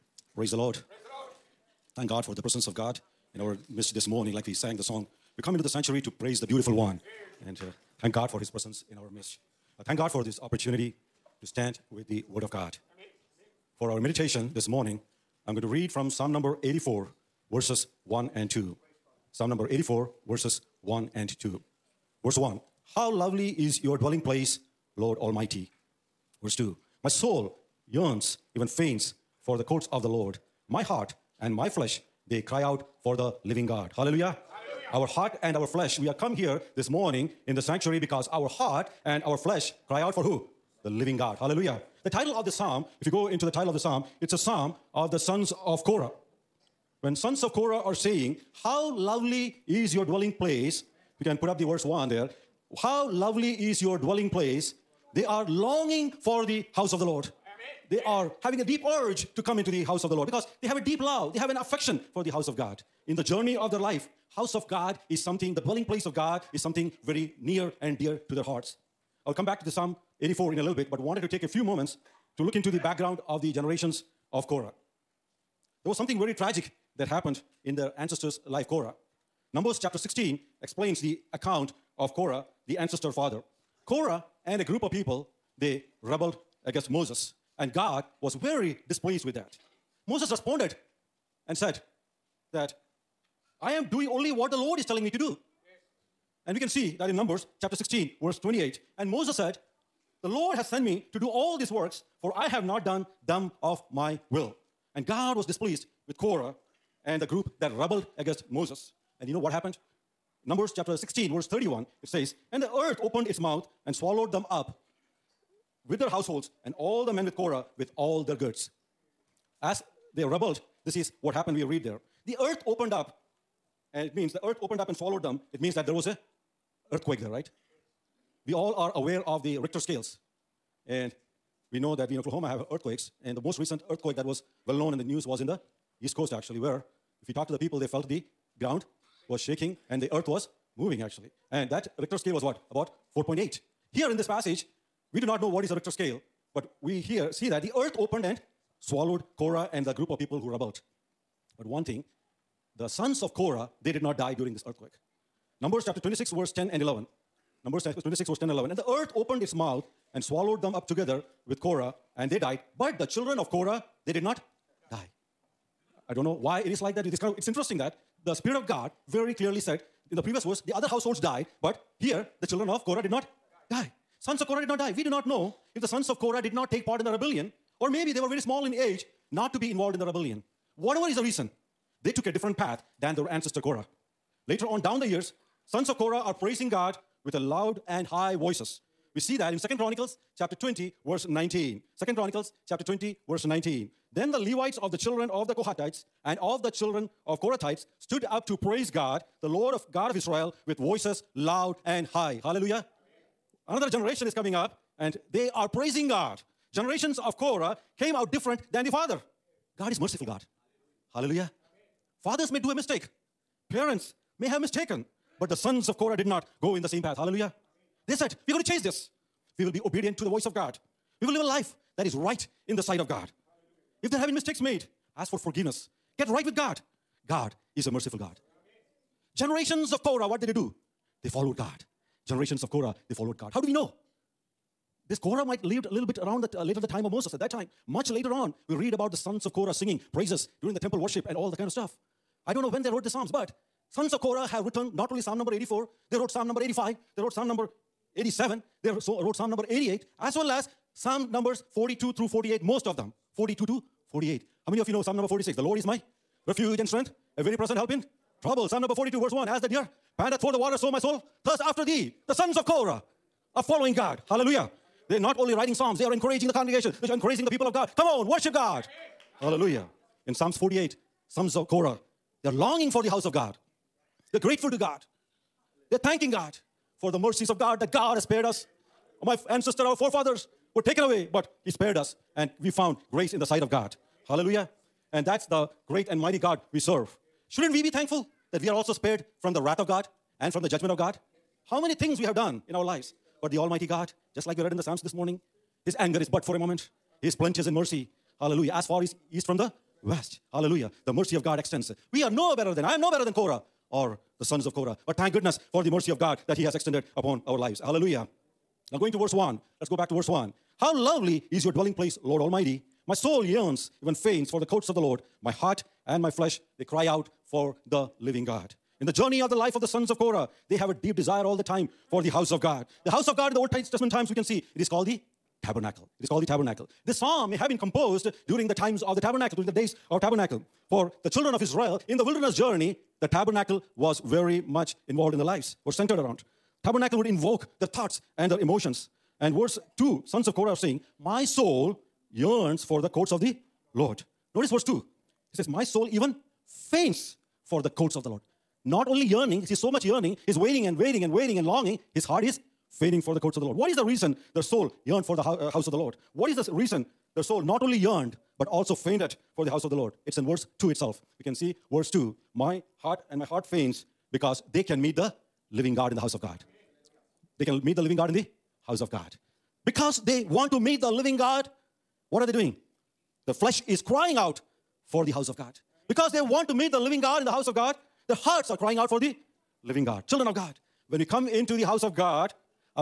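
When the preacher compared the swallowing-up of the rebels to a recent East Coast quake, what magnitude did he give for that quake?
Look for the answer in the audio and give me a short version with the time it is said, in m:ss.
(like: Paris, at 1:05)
4.8, at 2:22.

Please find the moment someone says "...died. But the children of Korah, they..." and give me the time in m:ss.
2:42.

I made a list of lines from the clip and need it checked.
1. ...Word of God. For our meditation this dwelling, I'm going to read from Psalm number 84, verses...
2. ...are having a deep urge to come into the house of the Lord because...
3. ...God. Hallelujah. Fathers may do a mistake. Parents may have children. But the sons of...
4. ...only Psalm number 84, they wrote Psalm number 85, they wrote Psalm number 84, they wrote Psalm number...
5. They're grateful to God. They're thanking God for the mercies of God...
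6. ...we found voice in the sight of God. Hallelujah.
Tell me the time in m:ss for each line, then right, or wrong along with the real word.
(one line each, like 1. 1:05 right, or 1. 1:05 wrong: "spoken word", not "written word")
1. 0:12 wrong: "morning", not "dwelling"
2. 0:58 right
3. 3:30 wrong: "mistaken", not "children"
4. 4:05 wrong: "87", not "84"
5. 4:34 right
6. 4:42 wrong: "grace", not "voice".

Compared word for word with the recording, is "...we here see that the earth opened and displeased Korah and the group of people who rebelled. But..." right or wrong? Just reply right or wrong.
wrong.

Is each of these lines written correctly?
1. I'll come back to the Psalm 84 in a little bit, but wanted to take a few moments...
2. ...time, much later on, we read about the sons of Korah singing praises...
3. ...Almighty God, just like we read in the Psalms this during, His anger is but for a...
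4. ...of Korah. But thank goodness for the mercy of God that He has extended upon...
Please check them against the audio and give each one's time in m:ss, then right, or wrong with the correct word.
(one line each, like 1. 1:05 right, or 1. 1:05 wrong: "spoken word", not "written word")
1. 1:09 right
2. 3:57 right
3. 4:53 wrong: "morning", not "during"
4. 5:04 right.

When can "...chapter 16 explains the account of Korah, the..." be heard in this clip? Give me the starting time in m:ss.
1:19.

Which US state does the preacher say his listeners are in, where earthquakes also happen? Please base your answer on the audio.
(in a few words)
Oklahoma.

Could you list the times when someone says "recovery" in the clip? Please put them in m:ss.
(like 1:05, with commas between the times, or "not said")
not said.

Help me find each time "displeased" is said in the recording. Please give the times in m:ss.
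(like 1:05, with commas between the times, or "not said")
1:28, 1:45.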